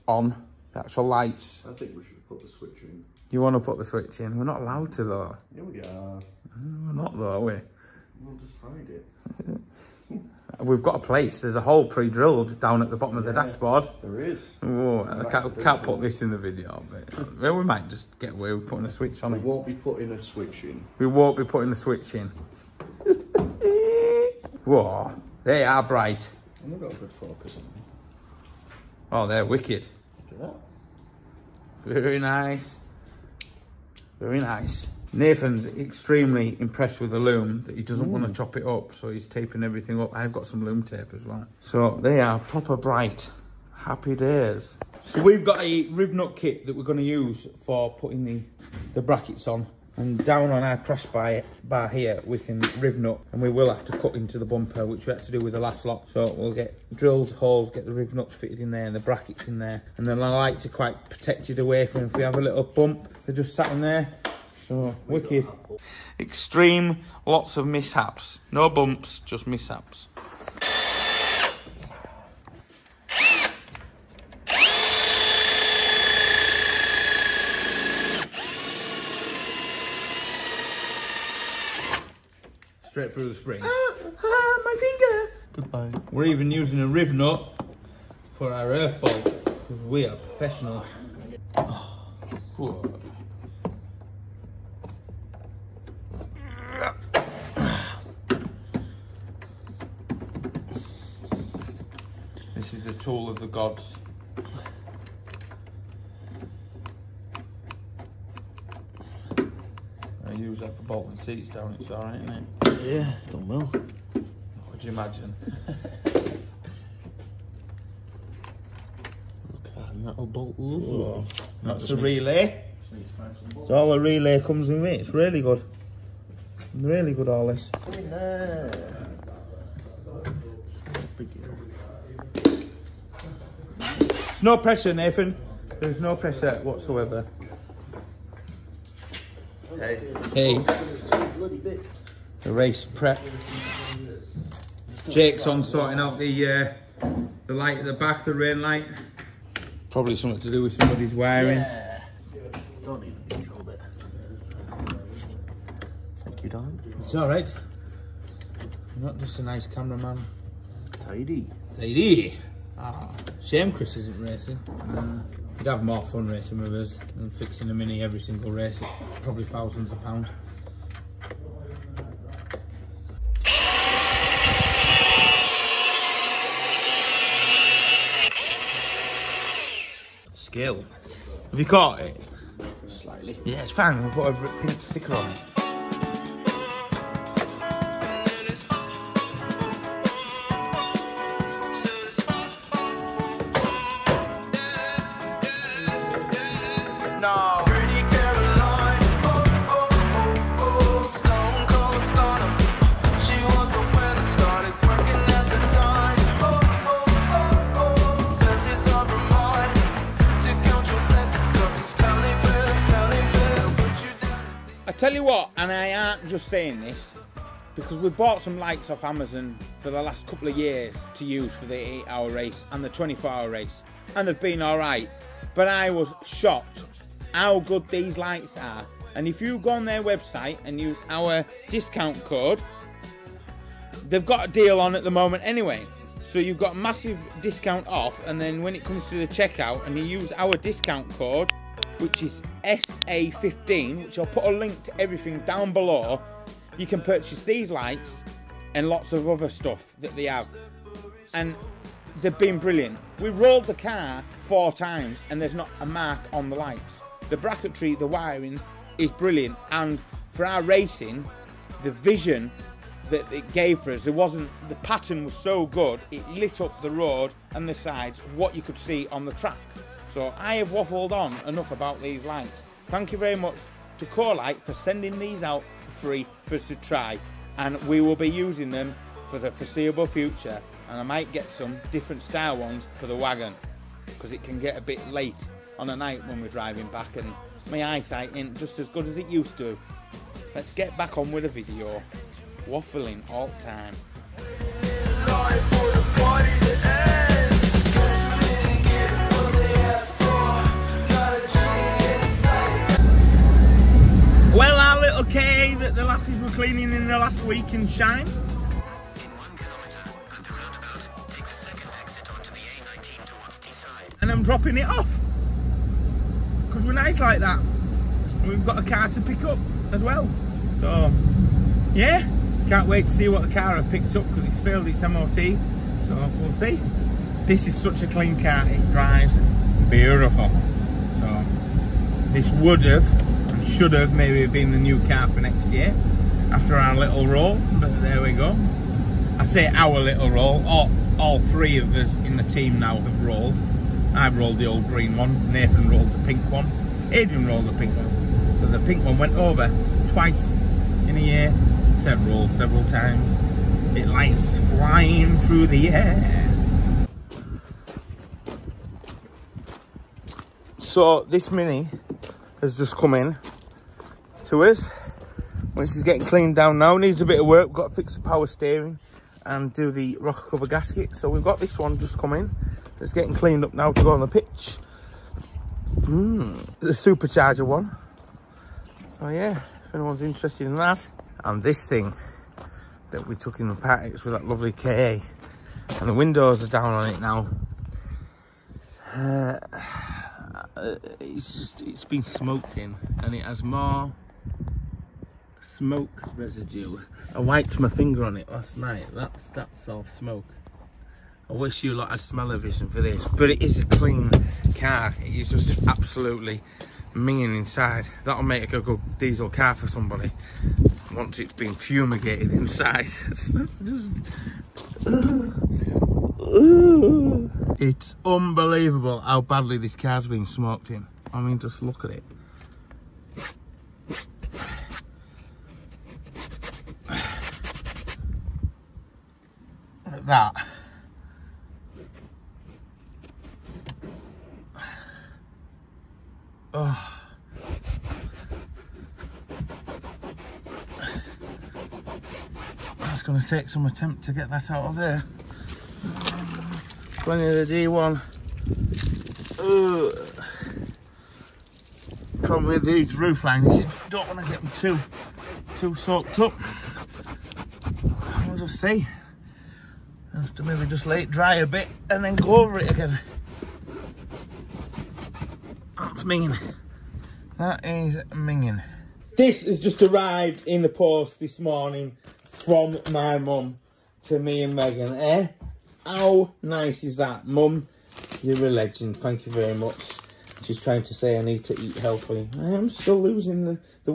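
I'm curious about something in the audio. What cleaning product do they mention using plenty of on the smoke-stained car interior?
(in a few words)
D1.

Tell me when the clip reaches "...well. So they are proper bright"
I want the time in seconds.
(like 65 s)
41 s.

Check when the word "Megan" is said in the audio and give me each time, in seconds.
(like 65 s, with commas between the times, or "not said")
474 s.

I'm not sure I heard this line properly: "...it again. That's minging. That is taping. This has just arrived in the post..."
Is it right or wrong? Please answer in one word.
wrong.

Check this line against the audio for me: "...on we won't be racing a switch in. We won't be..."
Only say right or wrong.
wrong.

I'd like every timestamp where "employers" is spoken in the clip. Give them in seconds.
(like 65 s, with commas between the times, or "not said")
not said.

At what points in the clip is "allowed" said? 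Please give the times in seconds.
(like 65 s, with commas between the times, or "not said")
4 s.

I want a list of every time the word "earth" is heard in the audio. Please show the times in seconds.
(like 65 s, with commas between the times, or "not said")
88 s.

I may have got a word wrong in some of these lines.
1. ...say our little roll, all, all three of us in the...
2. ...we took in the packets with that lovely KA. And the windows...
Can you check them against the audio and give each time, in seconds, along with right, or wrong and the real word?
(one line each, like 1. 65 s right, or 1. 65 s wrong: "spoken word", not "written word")
1. 339 s right
2. 383 s right.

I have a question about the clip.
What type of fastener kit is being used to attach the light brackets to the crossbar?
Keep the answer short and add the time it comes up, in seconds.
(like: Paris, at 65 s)
Riv nut kit, at 45 s.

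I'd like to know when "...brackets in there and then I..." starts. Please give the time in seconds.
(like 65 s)
58 s.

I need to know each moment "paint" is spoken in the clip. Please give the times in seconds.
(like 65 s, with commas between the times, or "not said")
not said.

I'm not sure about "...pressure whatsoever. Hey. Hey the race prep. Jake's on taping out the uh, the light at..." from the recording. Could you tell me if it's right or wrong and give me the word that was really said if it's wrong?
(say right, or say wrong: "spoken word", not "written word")
wrong: "sorting", not "taping".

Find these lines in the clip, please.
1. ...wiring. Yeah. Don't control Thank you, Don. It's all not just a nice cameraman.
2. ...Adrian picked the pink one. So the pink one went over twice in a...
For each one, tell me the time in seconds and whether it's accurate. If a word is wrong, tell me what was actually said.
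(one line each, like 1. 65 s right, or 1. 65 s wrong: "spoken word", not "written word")
1. 151 s right
2. 347 s wrong: "rolled", not "picked".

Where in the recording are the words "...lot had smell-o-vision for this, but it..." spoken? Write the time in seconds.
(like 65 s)
401 s.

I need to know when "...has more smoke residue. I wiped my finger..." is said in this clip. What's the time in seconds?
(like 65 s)
393 s.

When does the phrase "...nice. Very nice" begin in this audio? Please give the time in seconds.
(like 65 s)
32 s.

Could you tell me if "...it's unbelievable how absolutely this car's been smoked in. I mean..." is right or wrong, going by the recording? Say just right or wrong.
wrong.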